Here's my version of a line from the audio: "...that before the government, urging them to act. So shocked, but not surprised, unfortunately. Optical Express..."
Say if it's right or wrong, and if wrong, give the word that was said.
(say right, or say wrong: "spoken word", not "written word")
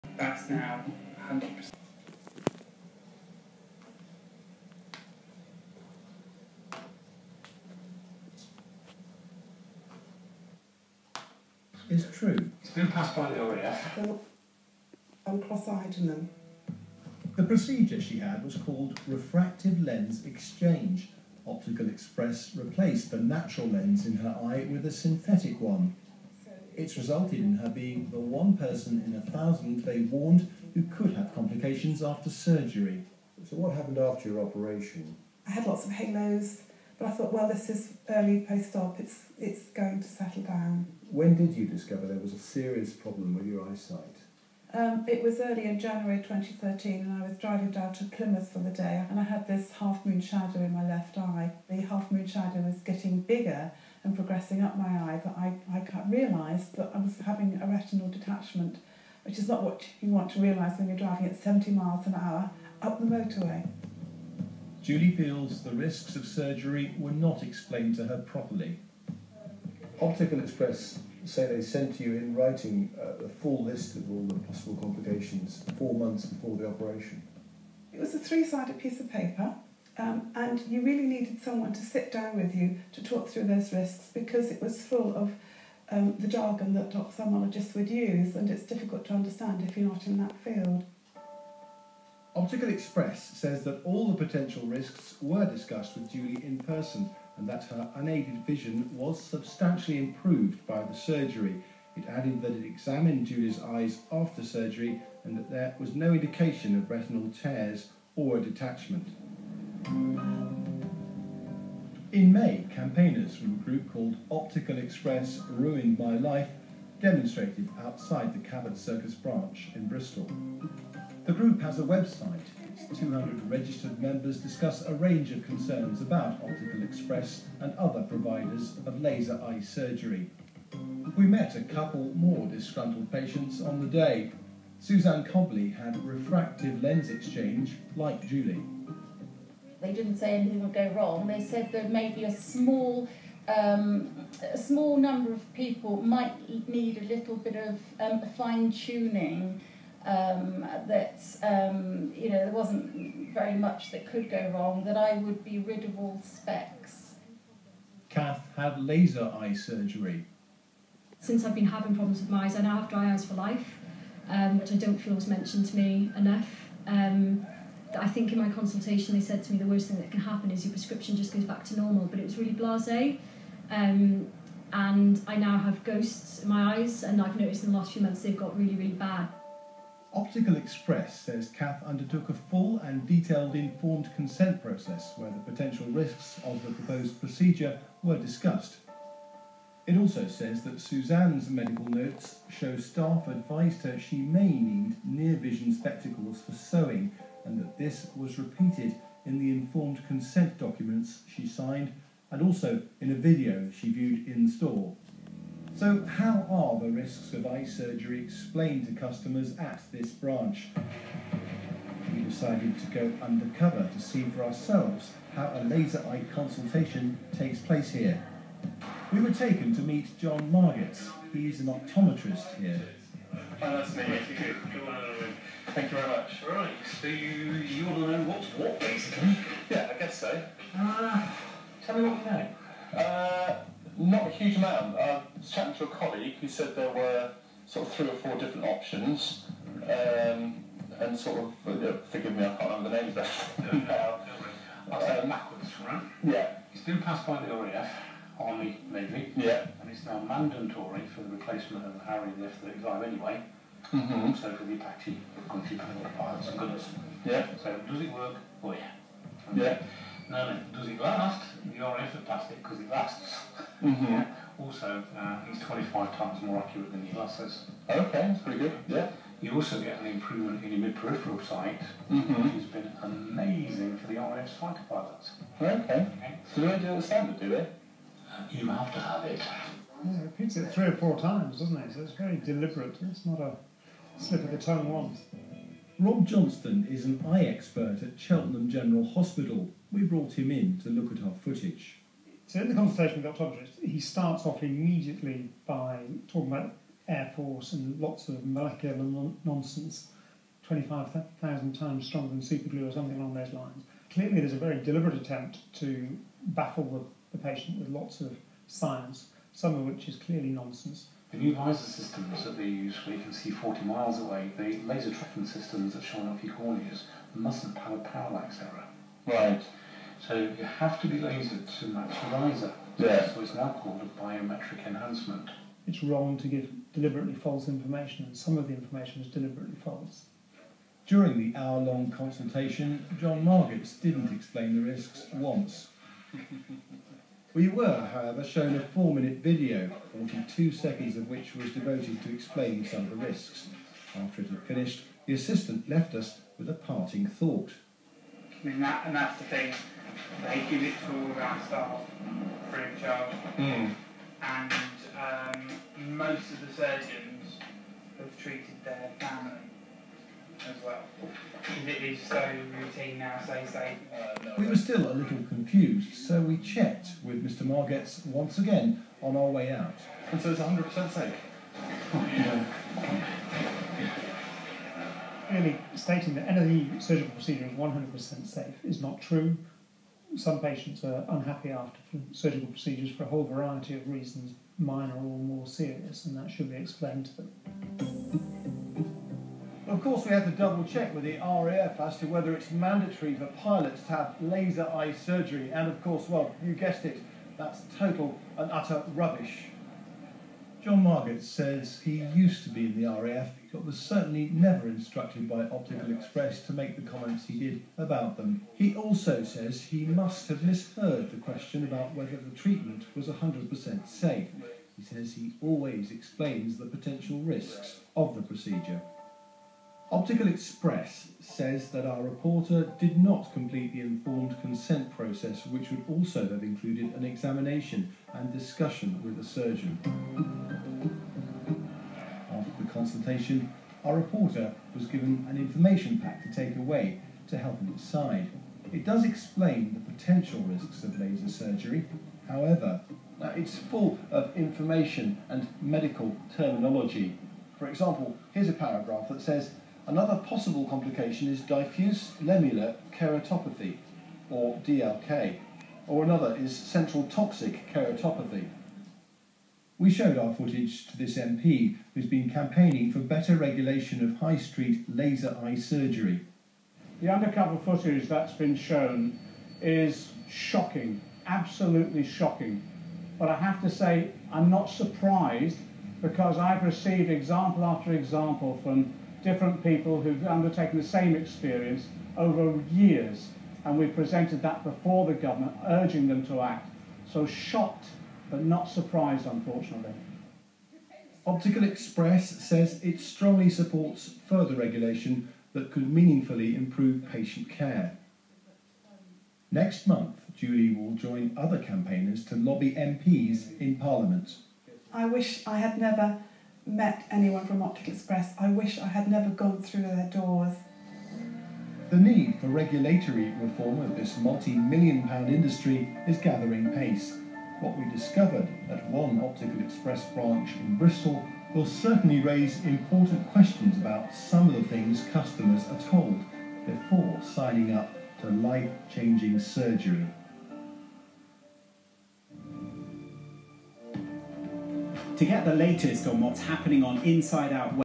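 right.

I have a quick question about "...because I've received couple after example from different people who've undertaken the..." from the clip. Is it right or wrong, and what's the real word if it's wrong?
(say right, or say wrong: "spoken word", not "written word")
wrong: "example", not "couple".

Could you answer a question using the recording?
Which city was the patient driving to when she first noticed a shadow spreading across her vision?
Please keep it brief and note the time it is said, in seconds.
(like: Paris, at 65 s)
Plymouth, at 48 s.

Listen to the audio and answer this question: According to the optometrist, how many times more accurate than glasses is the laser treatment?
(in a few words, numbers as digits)
25.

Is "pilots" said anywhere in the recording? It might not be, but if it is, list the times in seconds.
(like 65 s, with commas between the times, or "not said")
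274 s, 393 s.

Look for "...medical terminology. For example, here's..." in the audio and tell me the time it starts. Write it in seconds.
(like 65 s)
445 s.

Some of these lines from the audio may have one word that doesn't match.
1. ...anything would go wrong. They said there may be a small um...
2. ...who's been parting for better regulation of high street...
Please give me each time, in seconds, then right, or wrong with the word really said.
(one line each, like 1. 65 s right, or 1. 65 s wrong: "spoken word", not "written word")
1. 140 s right
2. 462 s wrong: "campaigning", not "parting".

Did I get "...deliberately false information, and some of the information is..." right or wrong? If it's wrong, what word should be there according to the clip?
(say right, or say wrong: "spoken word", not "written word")
right.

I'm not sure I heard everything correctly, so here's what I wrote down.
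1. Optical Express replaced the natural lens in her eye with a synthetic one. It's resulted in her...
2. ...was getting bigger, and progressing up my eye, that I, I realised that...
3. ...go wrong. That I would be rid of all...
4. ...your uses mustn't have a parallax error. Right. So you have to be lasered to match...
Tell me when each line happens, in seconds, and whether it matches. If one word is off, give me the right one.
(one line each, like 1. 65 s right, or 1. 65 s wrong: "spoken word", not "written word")
1. 21 s right
2. 52 s right
3. 154 s right
4. 316 s right.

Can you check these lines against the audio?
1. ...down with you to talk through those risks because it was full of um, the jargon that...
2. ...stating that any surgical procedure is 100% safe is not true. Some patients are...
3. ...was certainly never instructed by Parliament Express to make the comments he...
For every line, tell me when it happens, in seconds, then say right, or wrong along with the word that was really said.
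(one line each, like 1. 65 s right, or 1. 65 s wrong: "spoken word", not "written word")
1. 82 s right
2. 375 s right
3. 403 s wrong: "Optical", not "Parliament".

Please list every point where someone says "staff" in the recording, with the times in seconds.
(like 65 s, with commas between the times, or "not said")
192 s, 351 s.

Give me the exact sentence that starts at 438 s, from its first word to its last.
It does explain the potential risks of laser surgery.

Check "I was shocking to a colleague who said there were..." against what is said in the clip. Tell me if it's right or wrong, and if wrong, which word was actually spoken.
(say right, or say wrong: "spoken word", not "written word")
wrong: "chatting", not "shocking".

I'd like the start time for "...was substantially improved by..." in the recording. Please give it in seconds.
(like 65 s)
98 s.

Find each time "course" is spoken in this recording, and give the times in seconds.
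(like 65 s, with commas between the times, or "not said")
390 s, 396 s.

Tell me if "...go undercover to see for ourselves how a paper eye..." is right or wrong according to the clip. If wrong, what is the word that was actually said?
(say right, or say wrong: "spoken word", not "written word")
wrong: "laser", not "paper".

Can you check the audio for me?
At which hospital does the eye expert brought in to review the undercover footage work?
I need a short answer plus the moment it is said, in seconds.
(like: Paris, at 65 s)
Cheltenham General Hospital, at 288 s.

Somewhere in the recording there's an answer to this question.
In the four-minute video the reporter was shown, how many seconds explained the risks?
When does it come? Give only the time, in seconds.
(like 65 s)
340 s.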